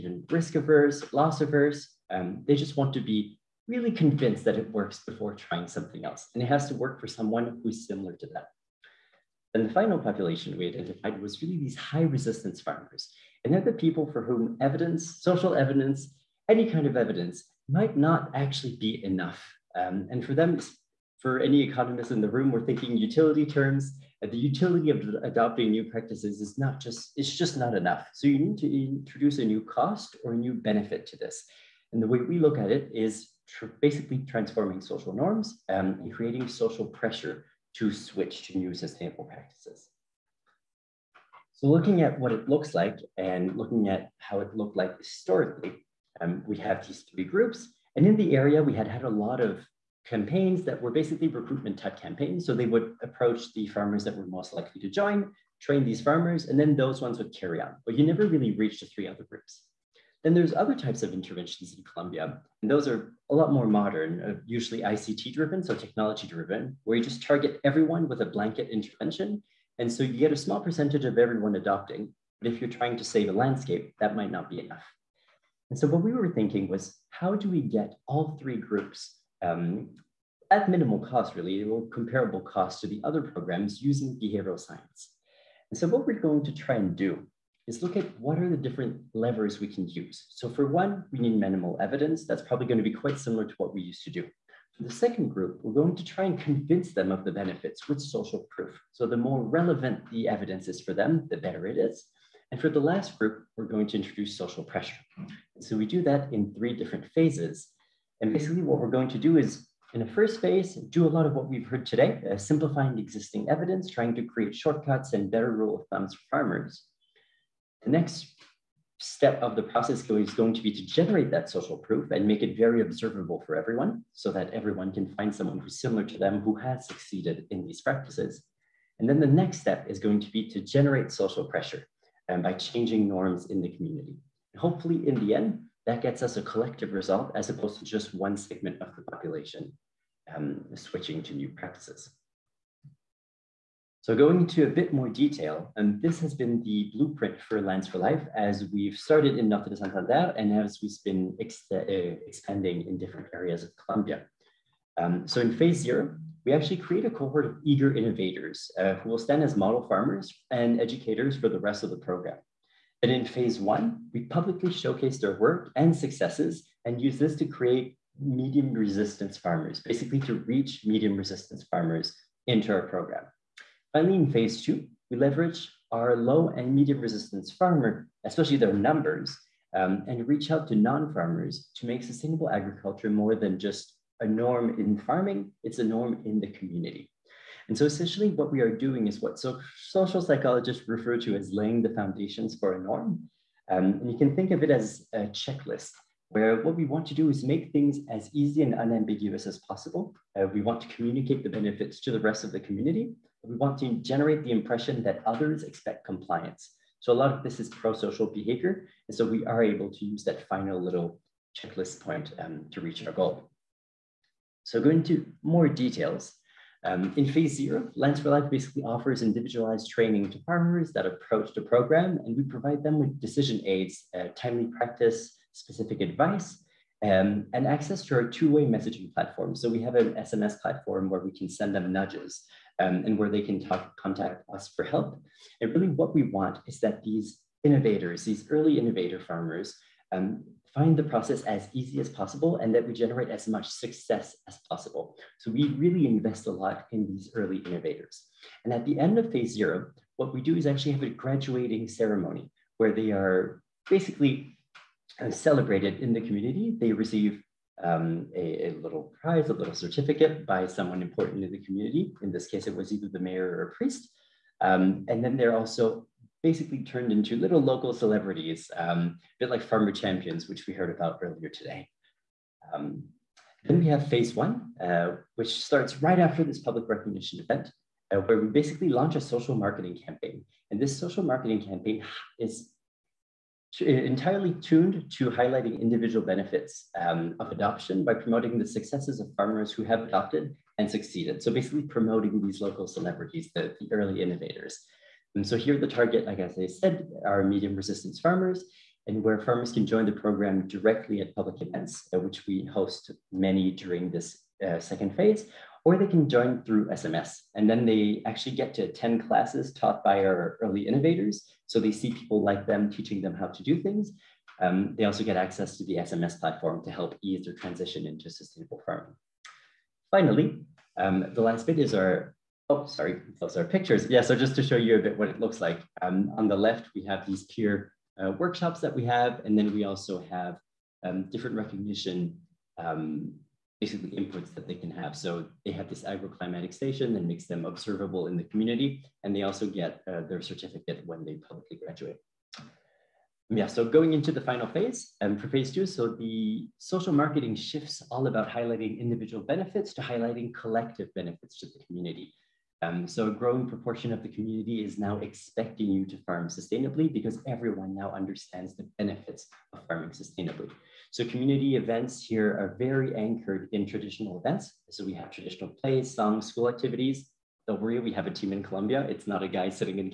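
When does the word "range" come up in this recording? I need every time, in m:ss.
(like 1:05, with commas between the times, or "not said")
not said.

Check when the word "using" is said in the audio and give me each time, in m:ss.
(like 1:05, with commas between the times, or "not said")
1:23.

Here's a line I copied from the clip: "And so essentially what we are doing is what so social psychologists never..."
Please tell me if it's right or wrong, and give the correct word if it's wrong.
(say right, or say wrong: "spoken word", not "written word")
wrong: "refer", not "never".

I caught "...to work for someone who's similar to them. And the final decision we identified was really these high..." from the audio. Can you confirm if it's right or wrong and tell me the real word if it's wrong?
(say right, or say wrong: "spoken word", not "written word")
wrong: "population", not "decision".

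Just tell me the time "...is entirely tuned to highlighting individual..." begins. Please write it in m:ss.
4:42.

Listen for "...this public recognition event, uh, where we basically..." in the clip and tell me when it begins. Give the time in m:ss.
4:36.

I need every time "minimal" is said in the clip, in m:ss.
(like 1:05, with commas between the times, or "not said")
1:20, 1:31.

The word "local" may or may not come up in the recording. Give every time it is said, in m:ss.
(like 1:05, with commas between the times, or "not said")
4:27, 4:52.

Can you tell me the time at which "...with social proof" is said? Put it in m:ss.
1:37.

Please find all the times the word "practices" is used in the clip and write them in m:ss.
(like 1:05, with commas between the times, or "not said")
0:25, 0:39, 2:07, 2:21, 3:44.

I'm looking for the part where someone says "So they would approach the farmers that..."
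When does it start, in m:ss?
0:52.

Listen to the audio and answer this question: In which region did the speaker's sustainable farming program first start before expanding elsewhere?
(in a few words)
Norte de Santander.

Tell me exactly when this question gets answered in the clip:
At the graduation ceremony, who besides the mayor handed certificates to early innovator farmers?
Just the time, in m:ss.
4:23.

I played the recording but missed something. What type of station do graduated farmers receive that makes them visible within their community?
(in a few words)
agroclimatic station.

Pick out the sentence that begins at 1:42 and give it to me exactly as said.
And for the last group, we're going to introduce social pressure.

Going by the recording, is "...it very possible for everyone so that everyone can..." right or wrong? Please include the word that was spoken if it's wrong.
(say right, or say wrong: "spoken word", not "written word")
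wrong: "observable", not "possible".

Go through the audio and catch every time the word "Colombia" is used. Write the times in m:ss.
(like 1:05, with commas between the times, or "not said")
1:01, 2:33, 6:08.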